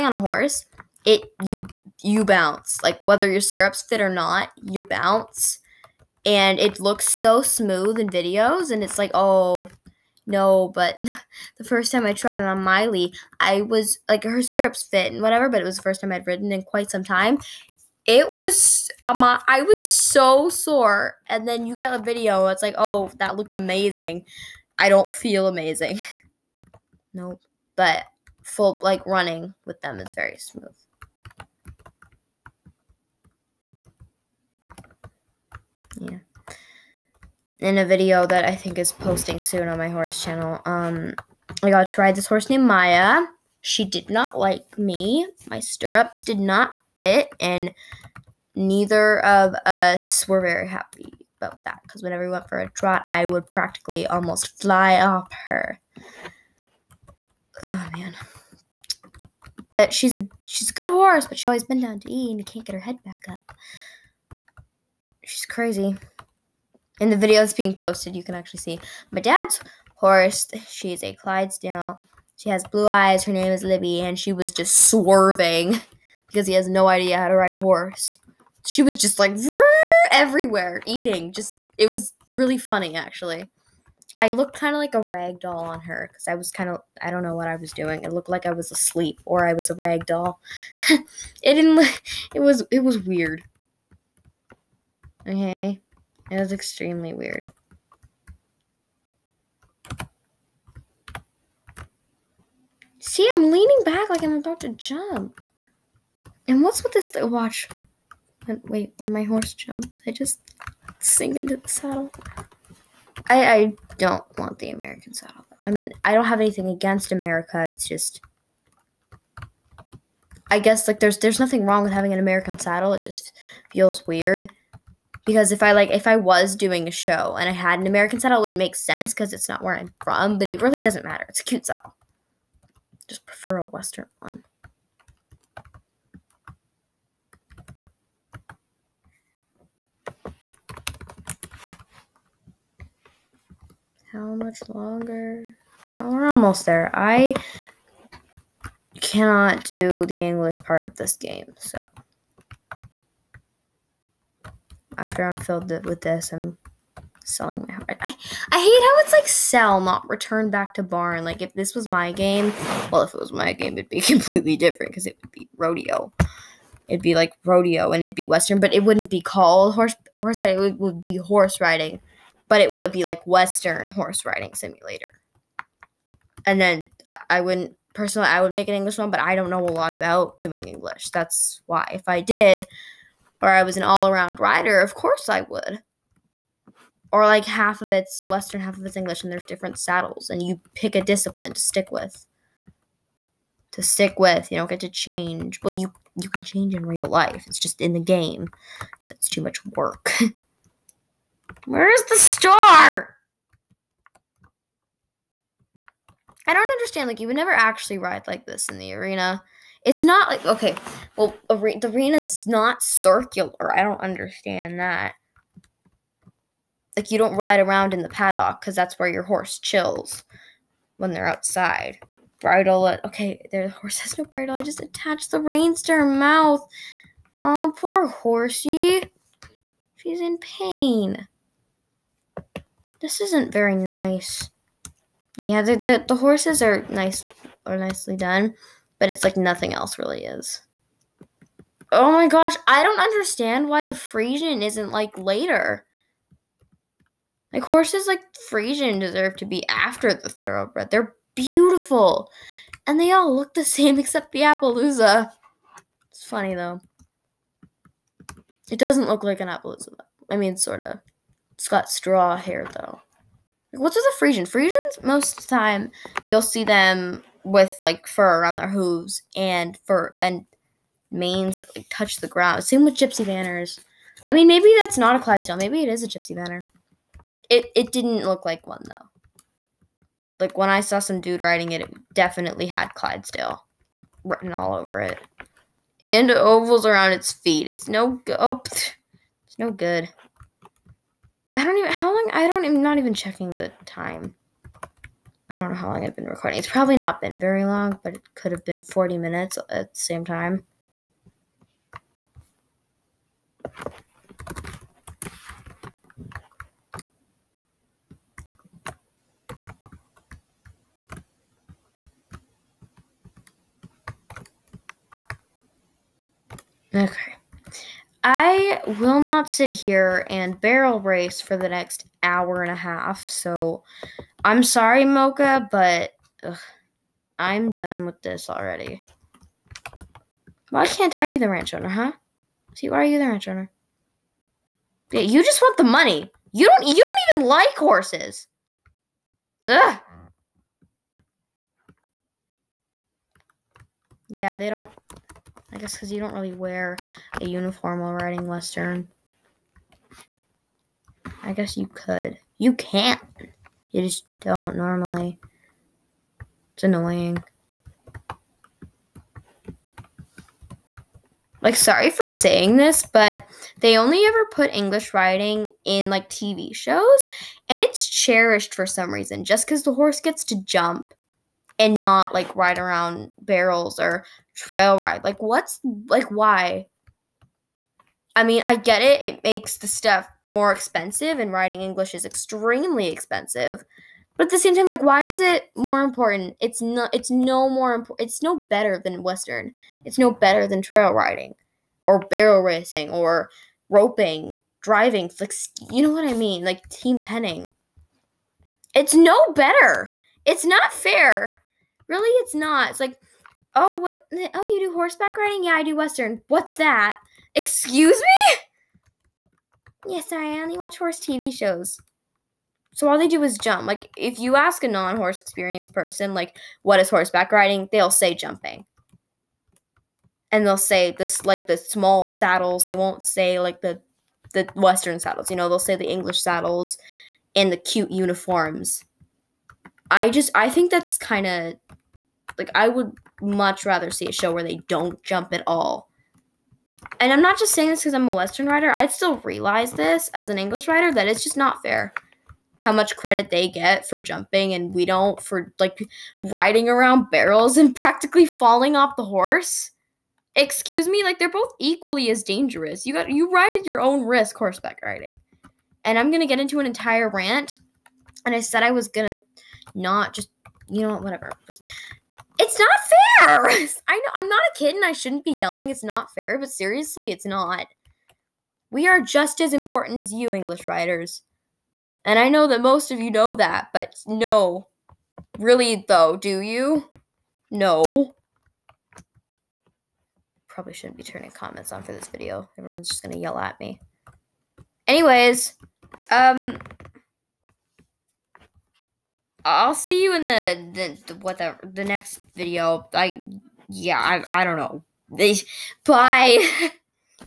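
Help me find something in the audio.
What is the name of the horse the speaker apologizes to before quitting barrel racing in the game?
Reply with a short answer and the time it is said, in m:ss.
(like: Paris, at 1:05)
Mocha, at 5:25.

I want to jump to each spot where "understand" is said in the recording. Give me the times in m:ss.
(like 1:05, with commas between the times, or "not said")
3:26, 3:34, 4:03.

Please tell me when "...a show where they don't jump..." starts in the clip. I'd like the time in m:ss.
7:14.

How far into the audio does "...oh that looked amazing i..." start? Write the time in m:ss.
0:22.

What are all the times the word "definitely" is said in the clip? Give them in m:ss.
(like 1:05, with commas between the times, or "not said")
4:42.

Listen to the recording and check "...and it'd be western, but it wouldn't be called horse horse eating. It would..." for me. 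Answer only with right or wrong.
wrong.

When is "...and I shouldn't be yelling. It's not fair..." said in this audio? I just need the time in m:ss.
7:44.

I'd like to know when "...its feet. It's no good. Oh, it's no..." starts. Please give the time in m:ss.
4:47.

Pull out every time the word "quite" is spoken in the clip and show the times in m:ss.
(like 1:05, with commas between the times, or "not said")
0:16.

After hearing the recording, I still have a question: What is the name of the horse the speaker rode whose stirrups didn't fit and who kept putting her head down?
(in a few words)
Maya.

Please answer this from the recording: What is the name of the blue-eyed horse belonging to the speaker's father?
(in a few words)
Libby.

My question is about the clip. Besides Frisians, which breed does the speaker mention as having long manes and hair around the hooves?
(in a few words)
Gypsy Vanners.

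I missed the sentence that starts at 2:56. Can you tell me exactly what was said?
And then I, I wouldn't personally.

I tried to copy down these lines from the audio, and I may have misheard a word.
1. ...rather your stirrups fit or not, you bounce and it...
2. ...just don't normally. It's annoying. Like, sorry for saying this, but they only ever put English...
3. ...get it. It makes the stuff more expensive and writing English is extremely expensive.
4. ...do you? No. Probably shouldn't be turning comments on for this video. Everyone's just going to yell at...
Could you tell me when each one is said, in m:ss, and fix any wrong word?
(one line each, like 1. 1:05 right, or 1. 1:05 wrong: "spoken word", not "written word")
1. 0:03 wrong: "whether", not "rather"
2. 5:54 right
3. 6:18 right
4. 7:56 right.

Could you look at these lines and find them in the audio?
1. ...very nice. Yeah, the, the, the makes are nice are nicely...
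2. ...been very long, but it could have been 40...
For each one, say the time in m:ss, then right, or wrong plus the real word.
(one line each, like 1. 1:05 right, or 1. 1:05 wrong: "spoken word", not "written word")
1. 3:53 wrong: "horses", not "makes"
2. 4:57 right.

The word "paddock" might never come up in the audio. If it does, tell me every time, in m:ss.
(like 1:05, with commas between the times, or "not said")
3:38.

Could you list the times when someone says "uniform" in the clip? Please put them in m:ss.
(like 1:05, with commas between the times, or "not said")
5:47, 7:08.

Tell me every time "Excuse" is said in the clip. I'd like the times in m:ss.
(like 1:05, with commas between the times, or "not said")
6:47, 7:30.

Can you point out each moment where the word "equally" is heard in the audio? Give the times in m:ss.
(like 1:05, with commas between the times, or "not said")
7:31.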